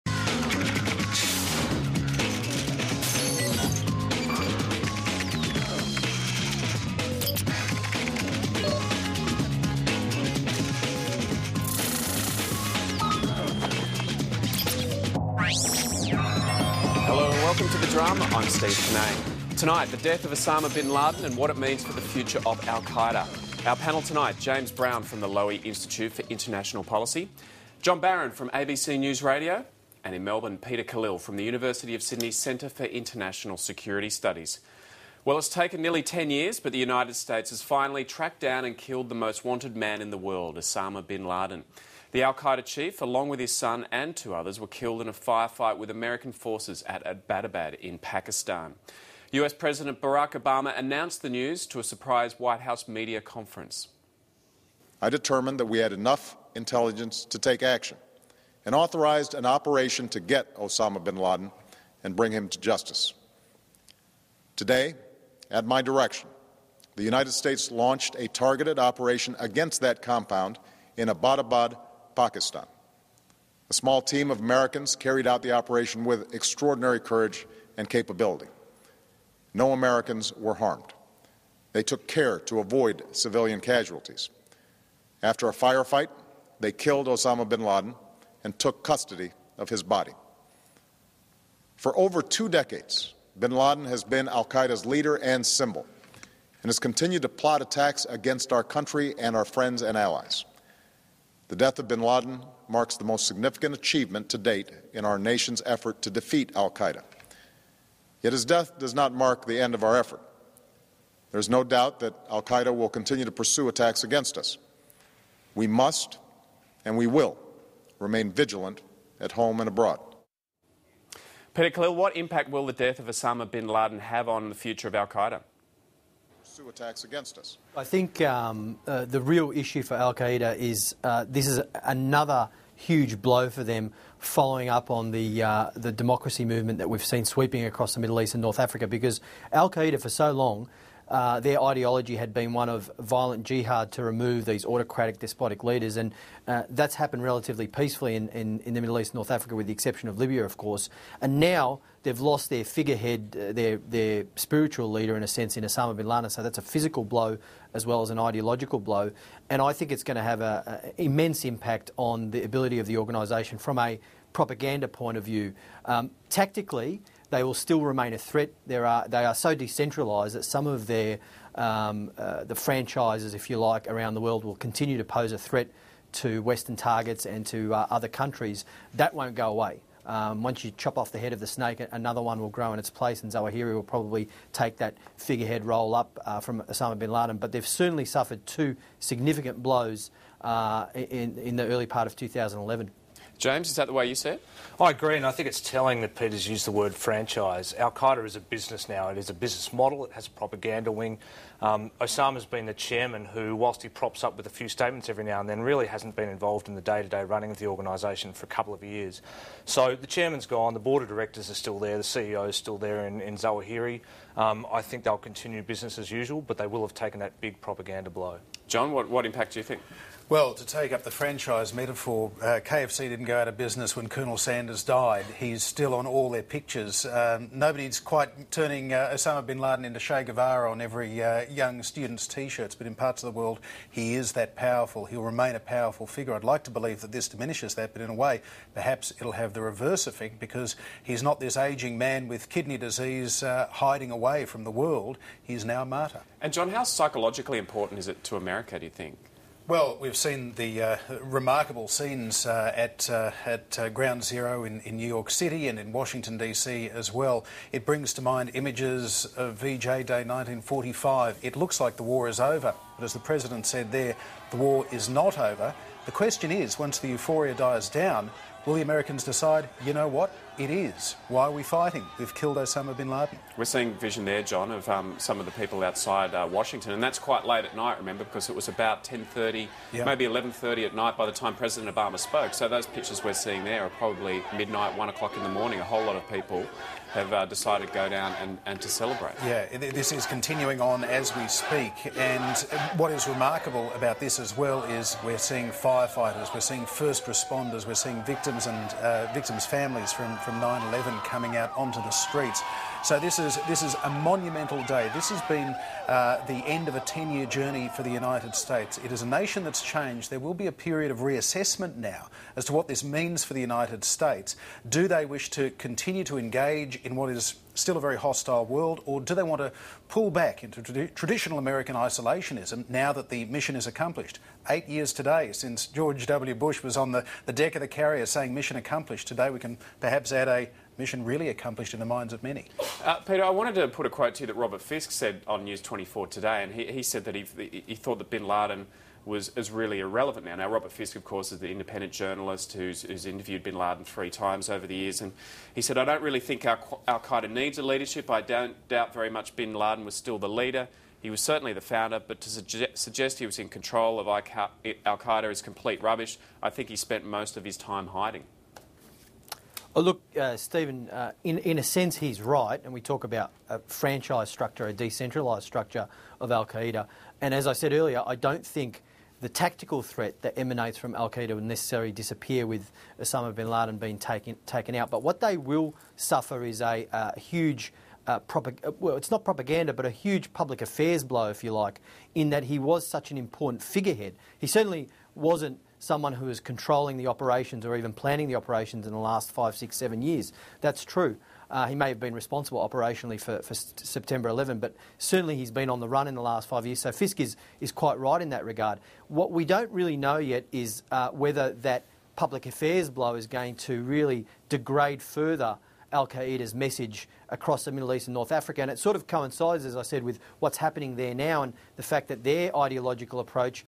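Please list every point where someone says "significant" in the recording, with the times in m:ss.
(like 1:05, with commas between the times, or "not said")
1:43, 3:08.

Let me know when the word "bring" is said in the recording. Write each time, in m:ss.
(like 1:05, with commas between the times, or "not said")
1:02, 4:17.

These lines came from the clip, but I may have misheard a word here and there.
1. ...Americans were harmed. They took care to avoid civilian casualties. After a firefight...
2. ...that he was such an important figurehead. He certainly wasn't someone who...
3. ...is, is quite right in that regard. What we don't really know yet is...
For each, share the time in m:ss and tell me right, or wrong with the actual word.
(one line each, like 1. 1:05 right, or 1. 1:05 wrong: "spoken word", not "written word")
1. 1:19 right
2. 6:22 right
3. 6:37 right.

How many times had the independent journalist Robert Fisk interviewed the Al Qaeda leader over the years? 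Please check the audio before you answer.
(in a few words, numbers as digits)
3.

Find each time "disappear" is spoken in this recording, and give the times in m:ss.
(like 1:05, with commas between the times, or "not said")
6:12.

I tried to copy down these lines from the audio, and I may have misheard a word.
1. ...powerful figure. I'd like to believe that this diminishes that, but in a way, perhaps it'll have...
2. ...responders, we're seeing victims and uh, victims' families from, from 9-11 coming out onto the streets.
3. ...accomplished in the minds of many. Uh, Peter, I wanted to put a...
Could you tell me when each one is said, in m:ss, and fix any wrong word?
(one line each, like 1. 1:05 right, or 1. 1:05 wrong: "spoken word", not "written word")
1. 3:55 right
2. 4:57 right
3. 5:31 right.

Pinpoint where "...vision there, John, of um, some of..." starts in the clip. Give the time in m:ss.
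4:33.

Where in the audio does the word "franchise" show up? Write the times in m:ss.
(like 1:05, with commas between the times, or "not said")
2:52, 3:16, 3:41, 6:03.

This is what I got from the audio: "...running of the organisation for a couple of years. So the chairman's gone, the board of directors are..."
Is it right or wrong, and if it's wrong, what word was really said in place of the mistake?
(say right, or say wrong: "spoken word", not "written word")
right.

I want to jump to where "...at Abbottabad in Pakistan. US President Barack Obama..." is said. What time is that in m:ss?
0:46.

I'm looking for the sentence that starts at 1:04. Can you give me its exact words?
Today, at my direction, the United States launched a targeted operation against that compound in Abbottabad, Pakistan.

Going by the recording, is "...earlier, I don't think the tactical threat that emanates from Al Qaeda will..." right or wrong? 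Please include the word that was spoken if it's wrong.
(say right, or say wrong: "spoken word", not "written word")
right.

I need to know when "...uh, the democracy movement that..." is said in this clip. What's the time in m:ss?
2:15.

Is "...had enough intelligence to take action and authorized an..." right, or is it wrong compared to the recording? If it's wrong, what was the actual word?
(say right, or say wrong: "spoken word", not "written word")
right.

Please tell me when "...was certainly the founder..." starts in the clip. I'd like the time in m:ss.
5:51.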